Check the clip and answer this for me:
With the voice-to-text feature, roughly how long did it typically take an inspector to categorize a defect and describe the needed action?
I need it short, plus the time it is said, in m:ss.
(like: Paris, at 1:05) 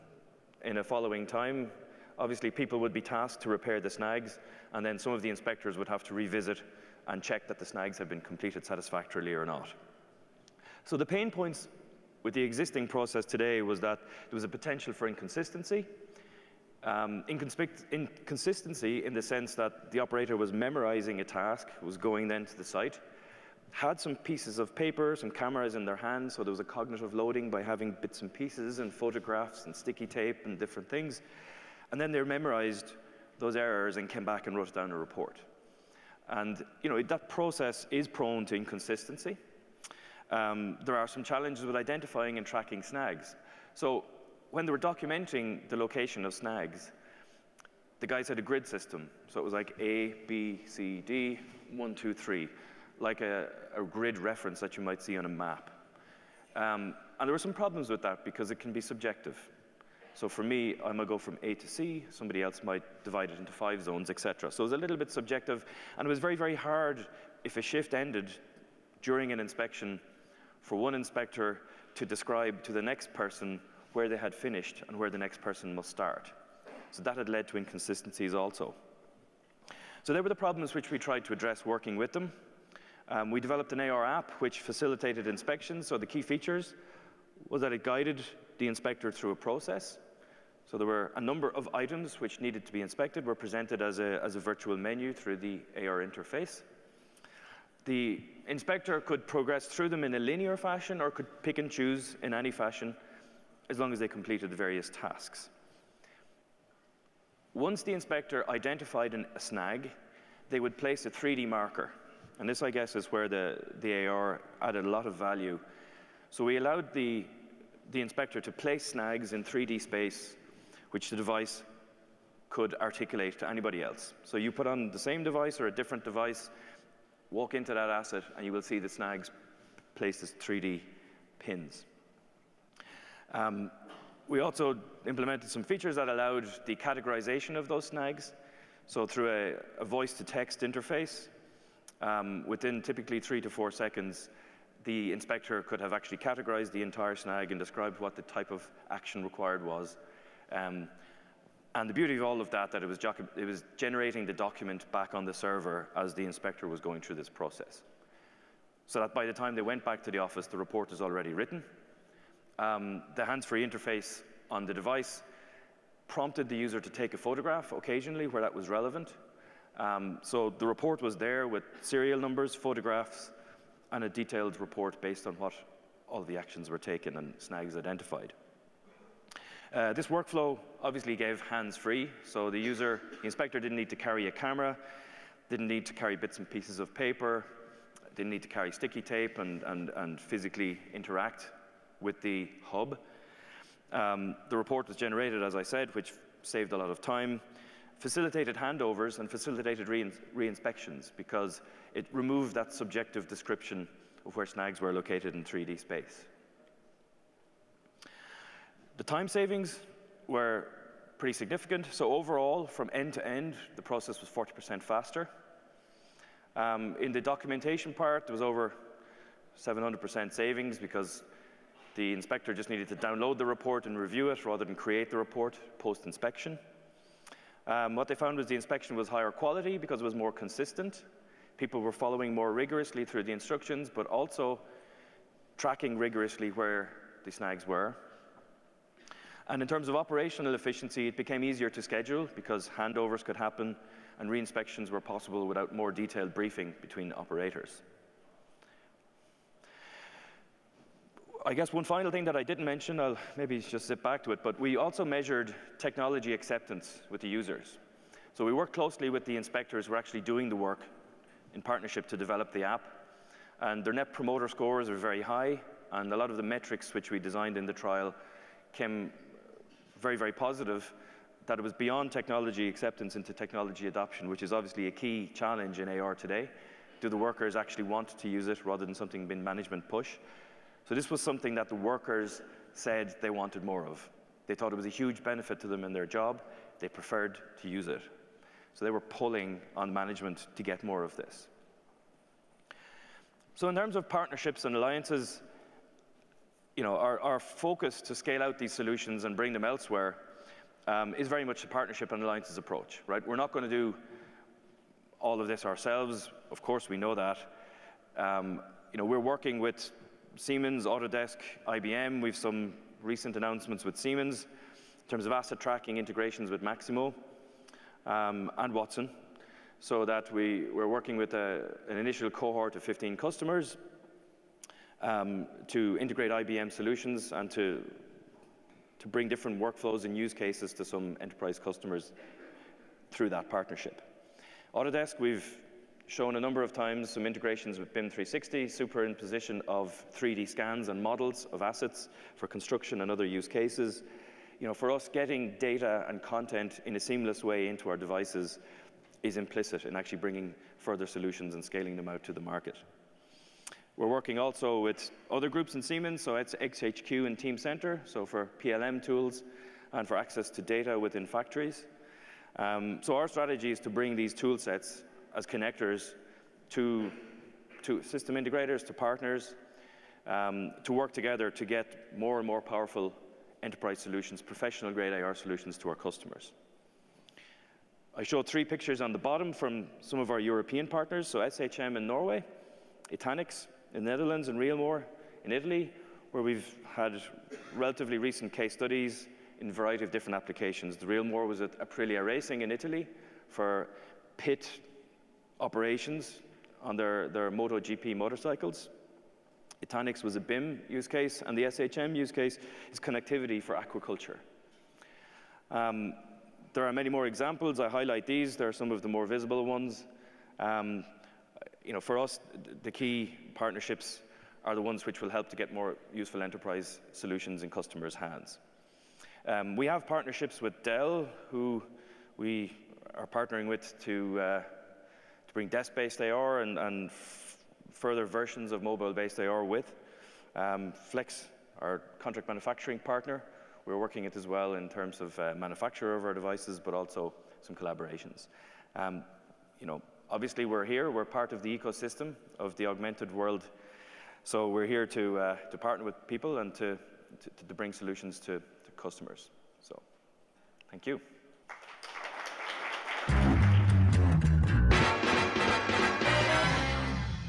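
3 to 4 seconds, at 2:23.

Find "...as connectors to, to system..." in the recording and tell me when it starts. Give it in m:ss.
6:05.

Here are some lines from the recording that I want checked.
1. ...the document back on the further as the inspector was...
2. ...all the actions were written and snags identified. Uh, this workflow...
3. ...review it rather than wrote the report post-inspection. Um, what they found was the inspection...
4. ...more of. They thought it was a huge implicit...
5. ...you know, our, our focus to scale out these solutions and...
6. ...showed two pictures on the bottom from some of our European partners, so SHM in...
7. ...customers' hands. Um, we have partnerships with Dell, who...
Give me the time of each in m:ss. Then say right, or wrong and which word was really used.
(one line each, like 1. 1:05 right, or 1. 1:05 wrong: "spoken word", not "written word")
1. 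2:34 wrong: "server", not "further"
2. 2:56 wrong: "taken", not "written"
3. 3:43 wrong: "create", not "wrote"
4. 4:43 wrong: "benefit", not "implicit"
5. 4:56 right
6. 6:18 wrong: "three", not "two"
7. 6:57 right.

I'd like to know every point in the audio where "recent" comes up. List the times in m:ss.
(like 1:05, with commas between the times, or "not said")
5:13, 6:28.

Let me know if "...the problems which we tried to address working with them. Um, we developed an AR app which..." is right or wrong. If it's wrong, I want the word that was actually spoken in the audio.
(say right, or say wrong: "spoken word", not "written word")
right.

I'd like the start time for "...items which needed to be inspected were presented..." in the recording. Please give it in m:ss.
1:31.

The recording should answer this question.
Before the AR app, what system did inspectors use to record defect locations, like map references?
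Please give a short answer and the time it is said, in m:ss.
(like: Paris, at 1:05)
grid system, at 0:48.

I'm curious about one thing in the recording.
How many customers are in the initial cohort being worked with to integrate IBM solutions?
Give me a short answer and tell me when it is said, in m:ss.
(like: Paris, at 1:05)
15, at 5:22.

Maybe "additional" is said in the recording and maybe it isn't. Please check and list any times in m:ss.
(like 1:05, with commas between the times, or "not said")
not said.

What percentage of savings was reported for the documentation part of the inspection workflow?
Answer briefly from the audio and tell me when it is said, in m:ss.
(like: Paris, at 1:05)
over 700%, at 3:38.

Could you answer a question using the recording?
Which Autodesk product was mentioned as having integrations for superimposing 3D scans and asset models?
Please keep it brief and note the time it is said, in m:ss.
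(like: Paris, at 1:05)
BIM 360, at 5:37.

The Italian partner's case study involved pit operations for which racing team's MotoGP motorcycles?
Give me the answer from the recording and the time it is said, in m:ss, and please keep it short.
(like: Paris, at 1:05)
Aprilia Racing, at 6:31.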